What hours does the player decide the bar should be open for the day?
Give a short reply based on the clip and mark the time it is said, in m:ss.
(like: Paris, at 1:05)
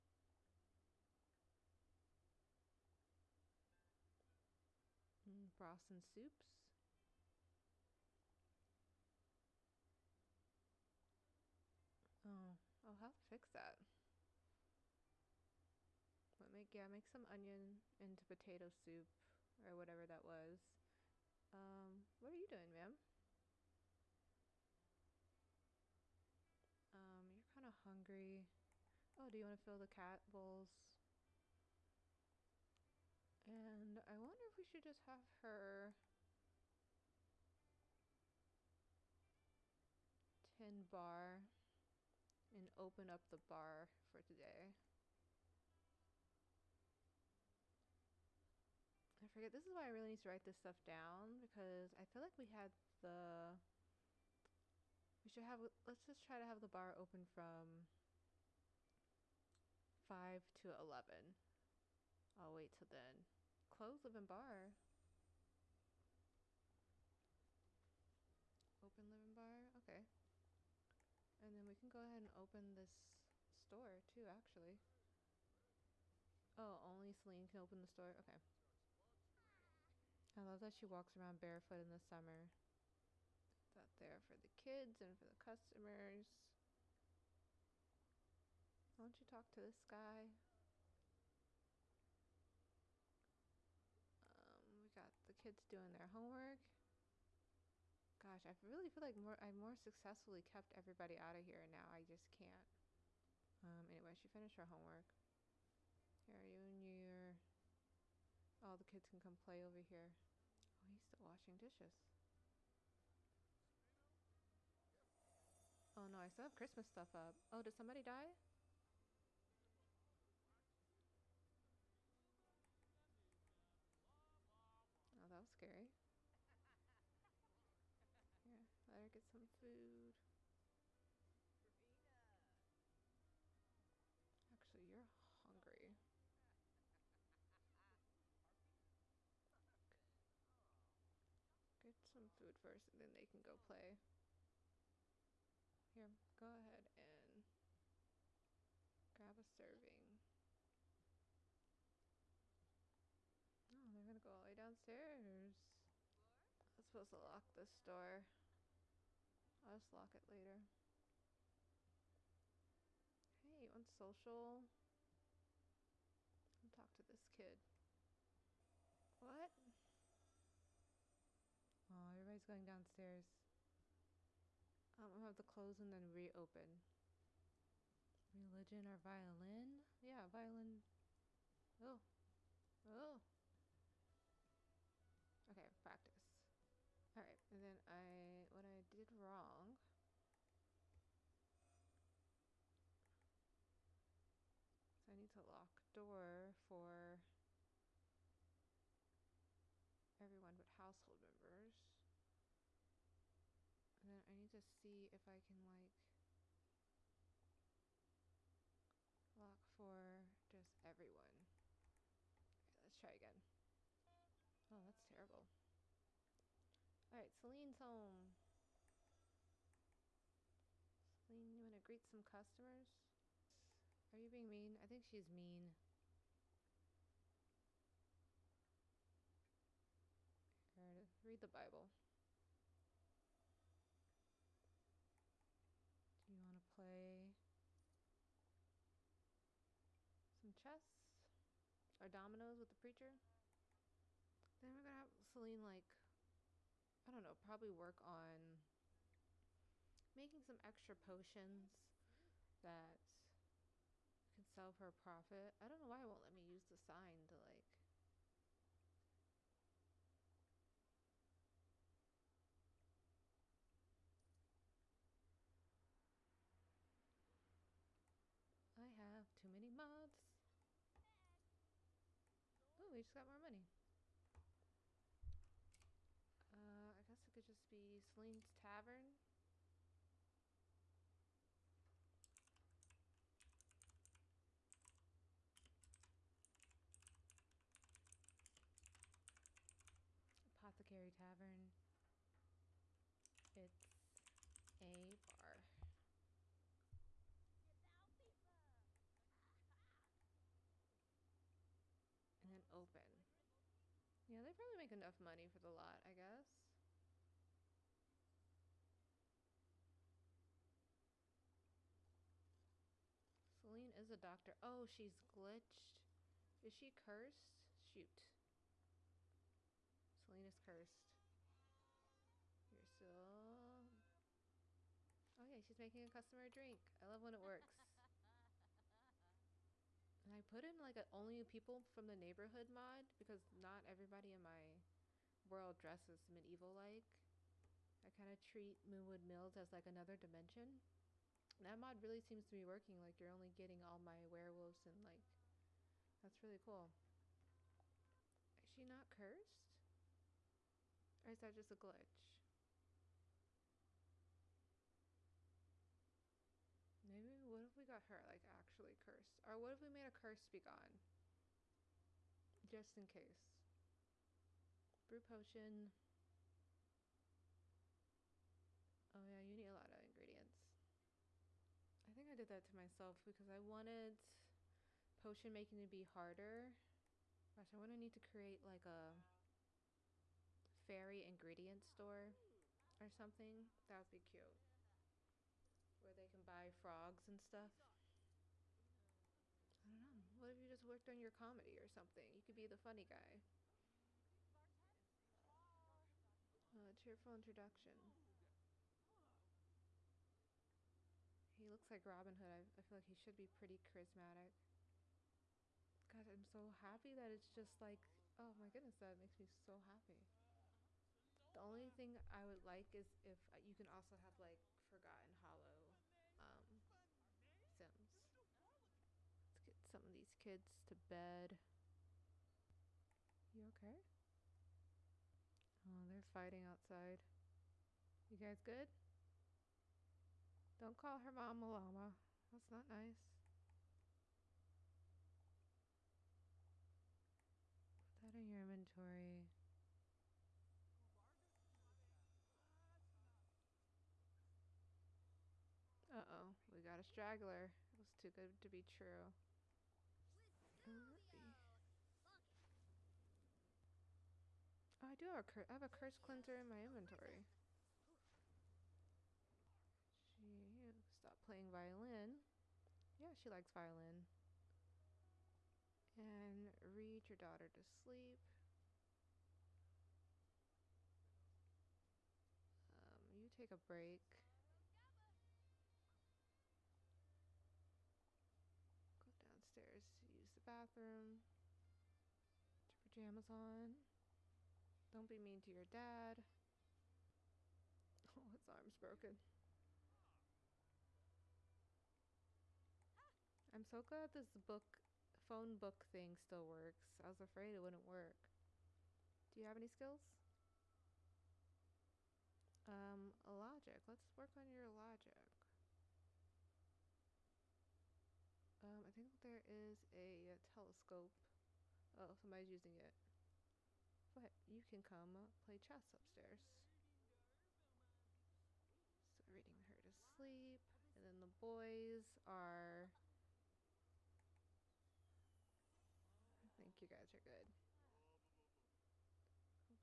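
5 to 11, at 1:00.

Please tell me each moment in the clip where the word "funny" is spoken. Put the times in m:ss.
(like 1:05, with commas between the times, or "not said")
6:32.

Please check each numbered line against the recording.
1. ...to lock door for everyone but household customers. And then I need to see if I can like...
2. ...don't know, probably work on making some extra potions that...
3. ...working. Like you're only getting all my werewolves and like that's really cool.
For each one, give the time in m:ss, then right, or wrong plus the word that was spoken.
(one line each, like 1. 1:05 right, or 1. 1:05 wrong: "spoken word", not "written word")
1. 3:15 wrong: "members", not "customers"
2. 4:07 right
3. 5:42 right.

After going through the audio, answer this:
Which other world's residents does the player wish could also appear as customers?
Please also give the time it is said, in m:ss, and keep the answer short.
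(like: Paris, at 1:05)
Forgotten Hollow, at 6:54.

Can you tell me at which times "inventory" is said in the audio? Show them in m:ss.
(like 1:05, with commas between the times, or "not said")
7:18, 7:36.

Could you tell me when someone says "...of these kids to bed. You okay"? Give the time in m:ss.
7:00.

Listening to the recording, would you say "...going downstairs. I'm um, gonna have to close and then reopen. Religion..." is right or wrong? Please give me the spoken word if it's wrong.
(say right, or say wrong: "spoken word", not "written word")
right.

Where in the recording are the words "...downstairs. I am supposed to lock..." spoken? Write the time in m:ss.
2:34.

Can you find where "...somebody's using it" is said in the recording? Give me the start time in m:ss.
8:32.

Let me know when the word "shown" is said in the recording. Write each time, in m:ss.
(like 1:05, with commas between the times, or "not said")
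not said.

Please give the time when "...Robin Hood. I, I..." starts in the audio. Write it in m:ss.
6:42.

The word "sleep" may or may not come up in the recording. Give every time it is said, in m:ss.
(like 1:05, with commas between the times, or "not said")
7:47, 8:40.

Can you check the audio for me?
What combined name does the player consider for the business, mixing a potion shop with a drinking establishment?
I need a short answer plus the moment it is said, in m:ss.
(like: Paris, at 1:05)
Apothecary Tavern, at 4:50.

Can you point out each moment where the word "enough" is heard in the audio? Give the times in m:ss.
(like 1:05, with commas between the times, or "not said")
5:04.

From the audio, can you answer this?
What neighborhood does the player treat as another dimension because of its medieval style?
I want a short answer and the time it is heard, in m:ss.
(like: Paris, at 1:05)
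Moonwood Mills, at 5:38.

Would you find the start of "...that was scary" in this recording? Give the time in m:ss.
2:05.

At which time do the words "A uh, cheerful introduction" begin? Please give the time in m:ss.
6:36.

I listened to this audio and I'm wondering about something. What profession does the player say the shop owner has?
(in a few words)
doctor.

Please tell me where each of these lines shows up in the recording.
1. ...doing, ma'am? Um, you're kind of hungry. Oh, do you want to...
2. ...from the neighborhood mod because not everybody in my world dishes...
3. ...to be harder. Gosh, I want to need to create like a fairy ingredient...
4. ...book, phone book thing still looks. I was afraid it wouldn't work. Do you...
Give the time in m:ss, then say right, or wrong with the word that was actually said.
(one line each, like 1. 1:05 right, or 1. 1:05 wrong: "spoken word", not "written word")
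1. 0:22 right
2. 5:31 wrong: "dresses", not "dishes"
3. 6:15 right
4. 8:14 wrong: "works", not "looks".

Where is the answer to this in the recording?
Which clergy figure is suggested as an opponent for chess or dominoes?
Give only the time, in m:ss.
4:02.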